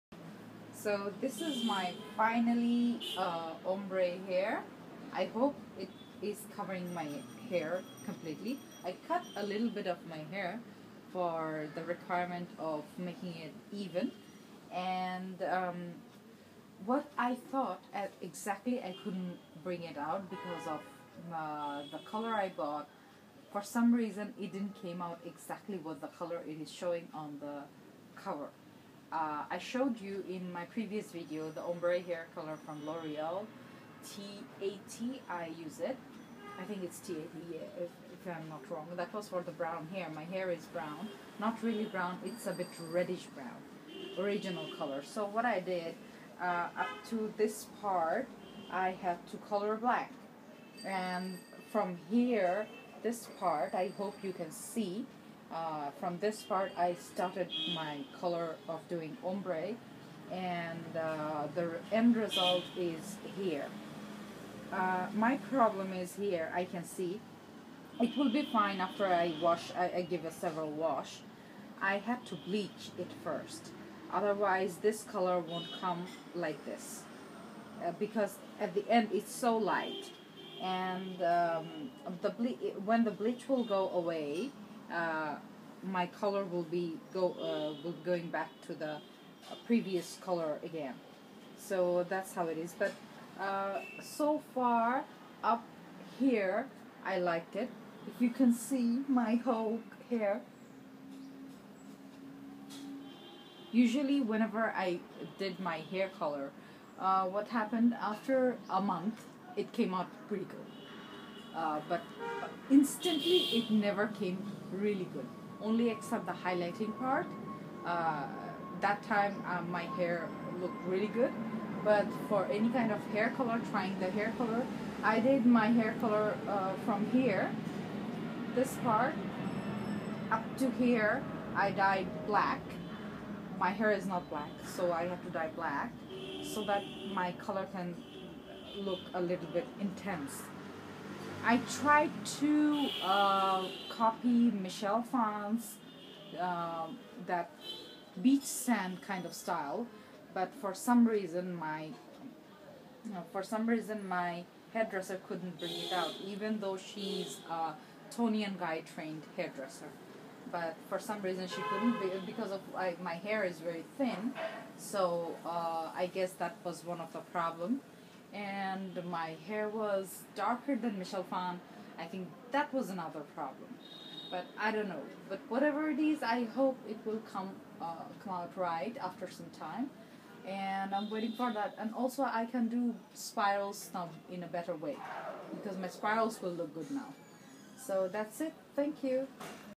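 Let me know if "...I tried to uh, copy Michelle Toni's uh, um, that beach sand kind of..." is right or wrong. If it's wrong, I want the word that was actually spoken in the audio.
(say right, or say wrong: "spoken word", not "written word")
wrong: "Phan", not "Toni".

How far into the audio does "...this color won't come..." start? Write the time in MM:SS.
01:14.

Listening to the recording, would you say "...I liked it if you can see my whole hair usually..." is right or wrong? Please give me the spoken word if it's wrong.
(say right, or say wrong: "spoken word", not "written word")
right.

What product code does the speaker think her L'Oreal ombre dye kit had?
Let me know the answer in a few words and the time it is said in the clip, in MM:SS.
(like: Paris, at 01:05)
T80, at 00:36.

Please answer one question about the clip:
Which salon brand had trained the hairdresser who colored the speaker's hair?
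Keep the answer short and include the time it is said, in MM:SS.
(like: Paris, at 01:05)
Toni and Guy, at 02:38.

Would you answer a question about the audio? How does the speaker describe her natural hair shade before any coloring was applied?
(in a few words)
reddish brown.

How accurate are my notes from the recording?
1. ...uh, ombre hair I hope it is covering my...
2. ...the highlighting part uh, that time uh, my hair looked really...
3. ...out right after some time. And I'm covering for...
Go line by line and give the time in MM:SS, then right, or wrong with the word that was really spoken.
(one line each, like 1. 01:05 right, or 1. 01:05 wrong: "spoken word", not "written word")
1. 00:03 right
2. 01:56 right
3. 02:58 wrong: "waiting", not "covering".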